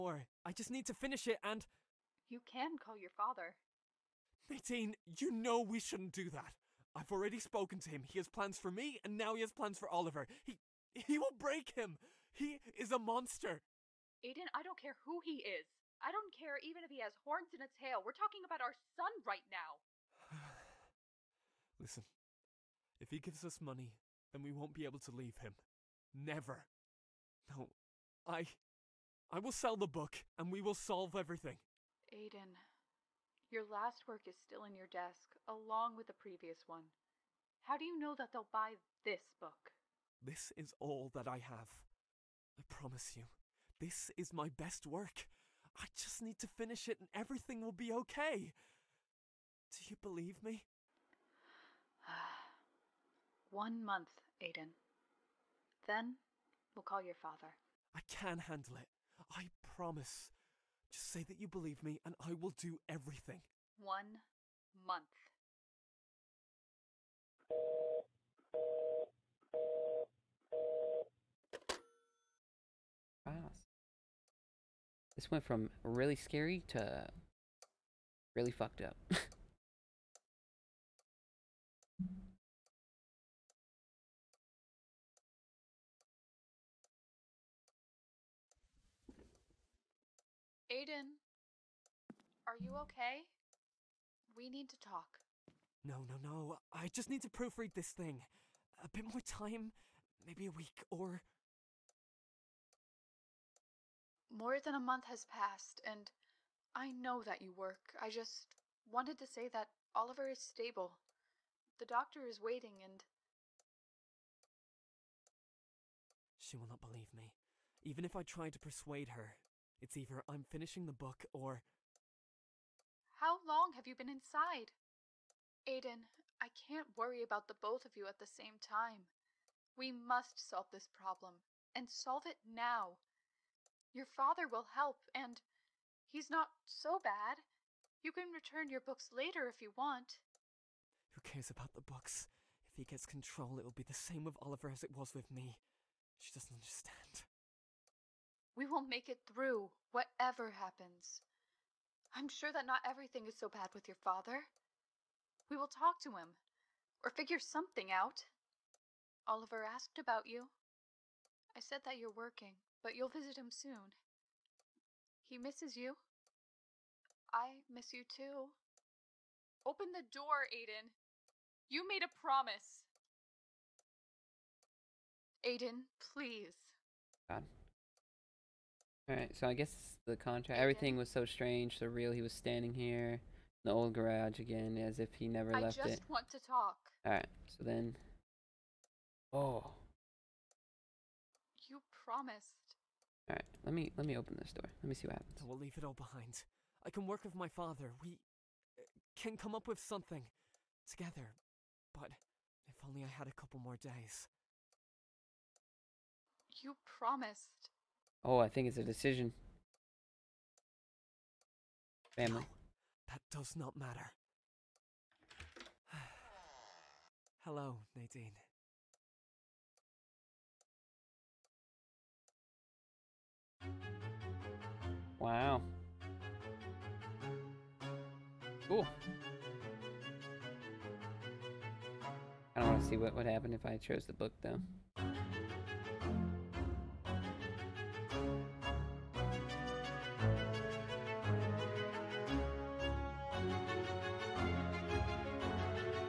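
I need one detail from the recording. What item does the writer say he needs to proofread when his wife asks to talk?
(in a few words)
this thing.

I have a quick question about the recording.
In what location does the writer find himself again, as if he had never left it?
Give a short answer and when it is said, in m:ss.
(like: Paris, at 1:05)
the old garage, at 3:03.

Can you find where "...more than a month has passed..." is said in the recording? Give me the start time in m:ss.
1:44.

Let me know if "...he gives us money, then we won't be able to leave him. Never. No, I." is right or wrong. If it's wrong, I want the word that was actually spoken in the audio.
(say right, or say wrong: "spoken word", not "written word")
right.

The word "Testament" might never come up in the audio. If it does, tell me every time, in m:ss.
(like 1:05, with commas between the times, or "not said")
not said.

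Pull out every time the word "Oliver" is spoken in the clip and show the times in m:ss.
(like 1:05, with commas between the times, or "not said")
0:09, 1:49, 2:24, 2:39.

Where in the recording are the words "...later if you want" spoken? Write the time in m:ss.
2:19.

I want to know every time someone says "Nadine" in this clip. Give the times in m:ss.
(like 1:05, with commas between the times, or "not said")
0:04, 3:37.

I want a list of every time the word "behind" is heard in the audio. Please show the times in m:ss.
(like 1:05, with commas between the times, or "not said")
3:15.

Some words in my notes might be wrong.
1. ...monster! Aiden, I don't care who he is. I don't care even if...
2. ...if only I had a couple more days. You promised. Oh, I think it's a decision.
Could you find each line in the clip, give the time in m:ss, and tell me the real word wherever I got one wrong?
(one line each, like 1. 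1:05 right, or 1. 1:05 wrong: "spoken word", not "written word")
1. 0:12 right
2. 3:22 right.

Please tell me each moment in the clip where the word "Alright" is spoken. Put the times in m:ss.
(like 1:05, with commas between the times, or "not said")
2:59, 3:07.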